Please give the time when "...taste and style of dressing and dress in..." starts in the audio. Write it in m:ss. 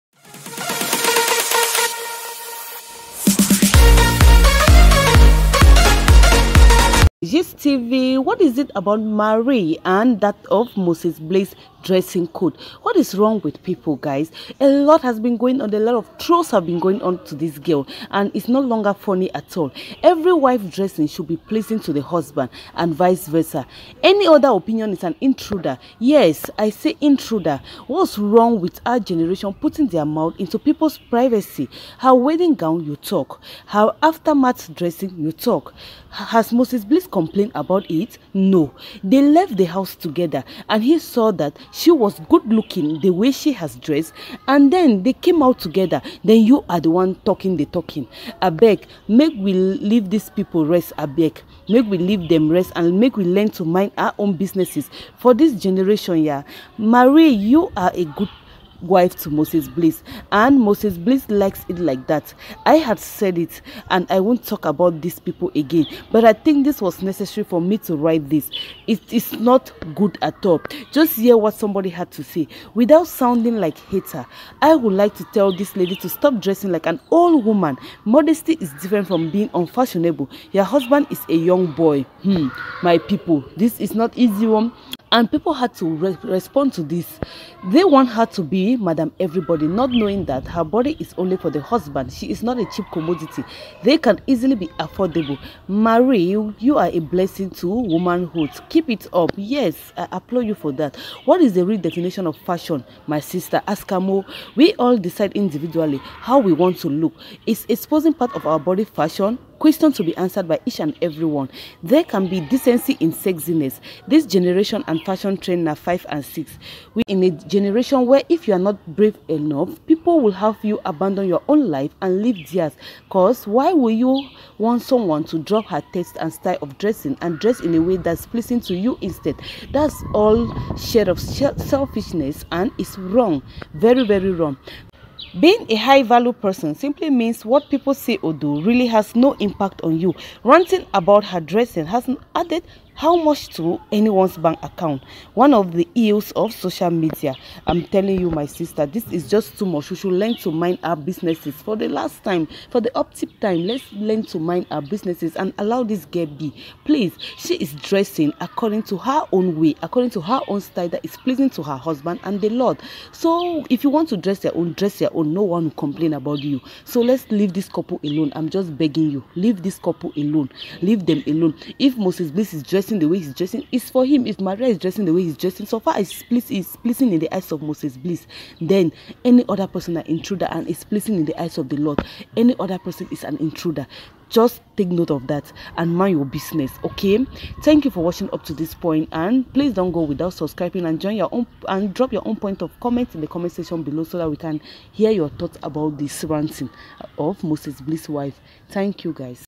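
2:05.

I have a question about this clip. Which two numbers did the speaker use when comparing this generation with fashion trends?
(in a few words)
5 and 6.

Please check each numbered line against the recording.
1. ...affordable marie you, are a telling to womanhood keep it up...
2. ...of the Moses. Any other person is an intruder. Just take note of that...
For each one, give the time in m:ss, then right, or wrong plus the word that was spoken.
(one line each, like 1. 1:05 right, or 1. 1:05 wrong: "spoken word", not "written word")
1. 1:34 wrong: "blessing", not "telling"
2. 3:01 wrong: "Lord", not "Moses".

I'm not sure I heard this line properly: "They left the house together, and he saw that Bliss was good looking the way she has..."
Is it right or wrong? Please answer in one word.
wrong.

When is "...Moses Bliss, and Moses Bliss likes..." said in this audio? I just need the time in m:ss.
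0:59.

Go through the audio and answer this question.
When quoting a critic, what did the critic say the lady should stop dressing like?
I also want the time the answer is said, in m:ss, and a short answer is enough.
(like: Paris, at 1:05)
An old woman, at 1:16.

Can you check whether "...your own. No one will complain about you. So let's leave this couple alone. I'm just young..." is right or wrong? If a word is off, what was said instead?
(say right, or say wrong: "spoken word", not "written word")
wrong: "begging", not "young".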